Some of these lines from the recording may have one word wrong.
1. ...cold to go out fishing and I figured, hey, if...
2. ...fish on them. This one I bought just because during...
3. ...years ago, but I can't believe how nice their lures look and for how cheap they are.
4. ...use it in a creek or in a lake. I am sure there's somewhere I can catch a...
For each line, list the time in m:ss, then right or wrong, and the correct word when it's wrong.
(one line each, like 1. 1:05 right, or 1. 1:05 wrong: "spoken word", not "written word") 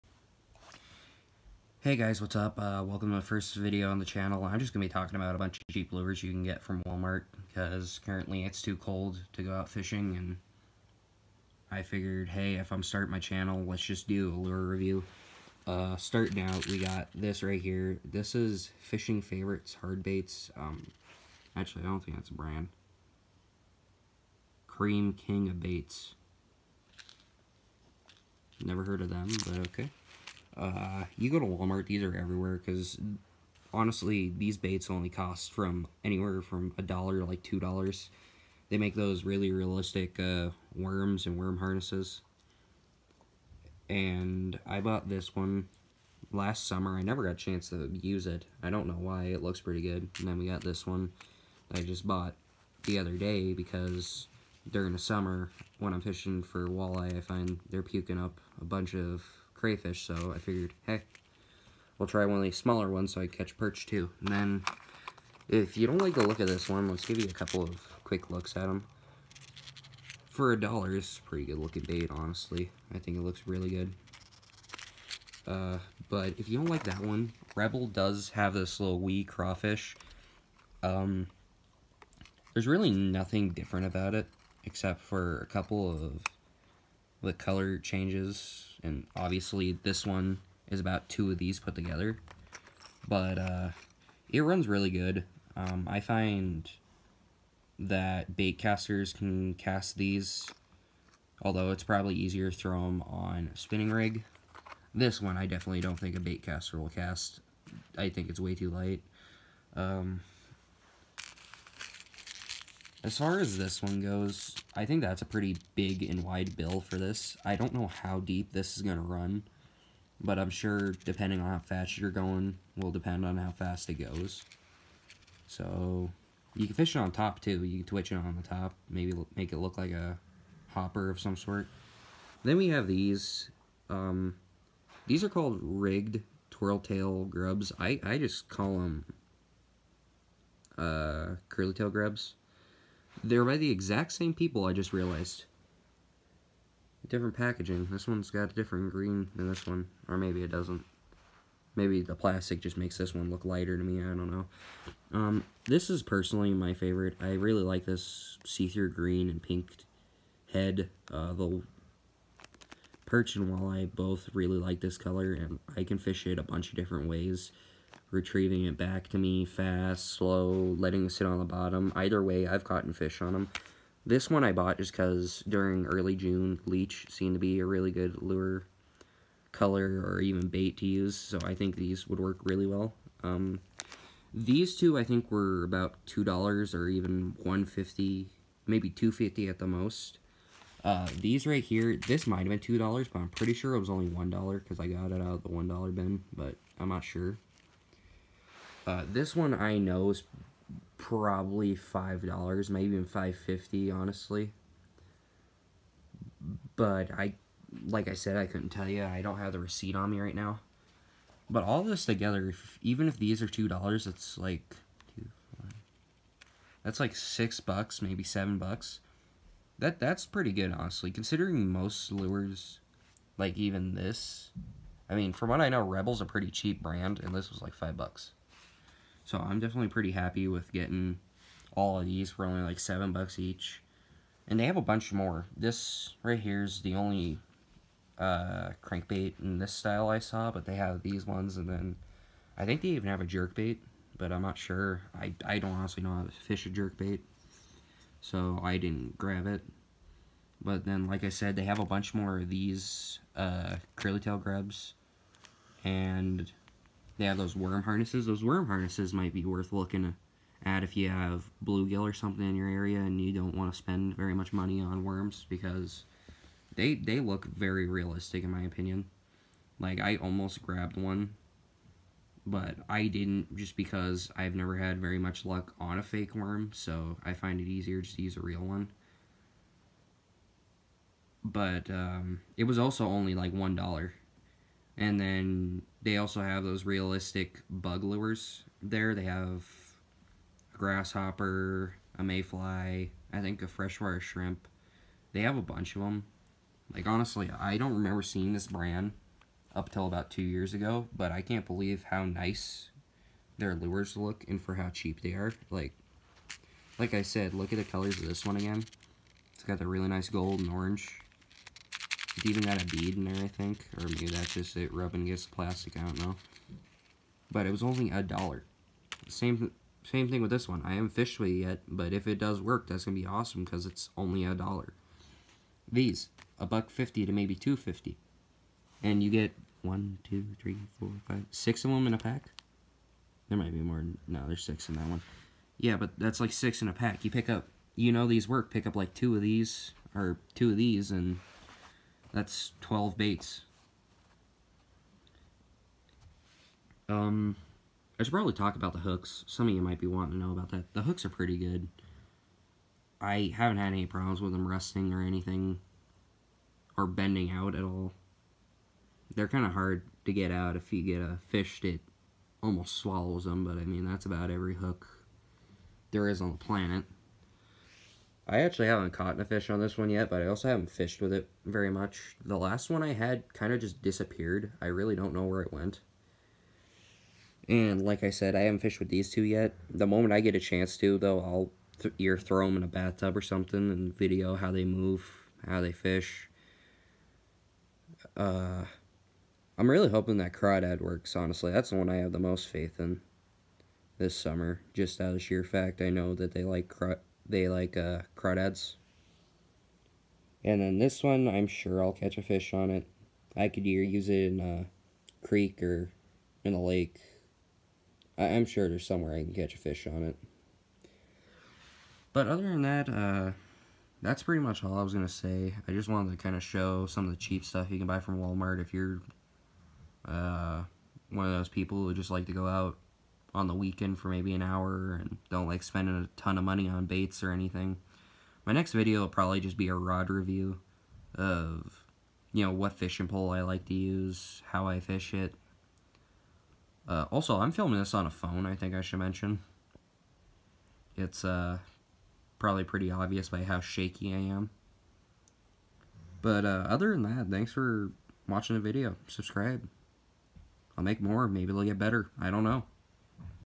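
1. 0:08 right
2. 2:52 right
3. 5:00 right
4. 6:44 right.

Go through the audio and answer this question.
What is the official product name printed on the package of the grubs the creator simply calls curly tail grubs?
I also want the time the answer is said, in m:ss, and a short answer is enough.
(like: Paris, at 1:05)
rigged twirl tail grubs, at 2:15.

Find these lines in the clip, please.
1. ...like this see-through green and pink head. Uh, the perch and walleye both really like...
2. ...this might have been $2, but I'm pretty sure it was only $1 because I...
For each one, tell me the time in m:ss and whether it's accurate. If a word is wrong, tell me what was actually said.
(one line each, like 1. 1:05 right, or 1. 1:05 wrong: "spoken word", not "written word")
1. 2:37 right
2. 3:12 right.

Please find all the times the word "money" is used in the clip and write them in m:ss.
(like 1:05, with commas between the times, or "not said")
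4:24, 7:06.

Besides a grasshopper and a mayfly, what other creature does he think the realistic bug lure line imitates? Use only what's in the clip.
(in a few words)
freshwater shrimp.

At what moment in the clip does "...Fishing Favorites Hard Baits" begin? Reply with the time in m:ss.
0:18.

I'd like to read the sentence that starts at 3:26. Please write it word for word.
But I, like I said, I couldn't tell you.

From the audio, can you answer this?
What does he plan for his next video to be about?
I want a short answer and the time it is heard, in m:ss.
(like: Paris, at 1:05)
a rod review, at 7:09.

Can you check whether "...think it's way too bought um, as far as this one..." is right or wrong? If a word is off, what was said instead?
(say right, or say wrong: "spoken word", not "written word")
wrong: "light", not "bought".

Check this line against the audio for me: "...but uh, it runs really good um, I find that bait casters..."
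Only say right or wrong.
right.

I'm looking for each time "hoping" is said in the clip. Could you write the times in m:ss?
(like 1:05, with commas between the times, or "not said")
6:30.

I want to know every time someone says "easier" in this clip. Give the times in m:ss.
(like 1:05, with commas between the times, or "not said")
1:42, 4:37.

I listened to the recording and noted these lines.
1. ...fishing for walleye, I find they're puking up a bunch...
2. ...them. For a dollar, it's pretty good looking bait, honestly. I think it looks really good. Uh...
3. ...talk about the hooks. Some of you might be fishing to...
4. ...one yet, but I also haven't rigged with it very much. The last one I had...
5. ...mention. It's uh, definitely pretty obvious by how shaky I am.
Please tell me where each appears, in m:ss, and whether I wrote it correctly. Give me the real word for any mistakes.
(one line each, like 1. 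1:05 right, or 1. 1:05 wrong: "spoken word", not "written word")
1. 0:56 right
2. 1:08 right
3. 5:48 wrong: "wanting", not "fishing"
4. 6:09 wrong: "fished", not "rigged"
5. 7:19 wrong: "probably", not "definitely".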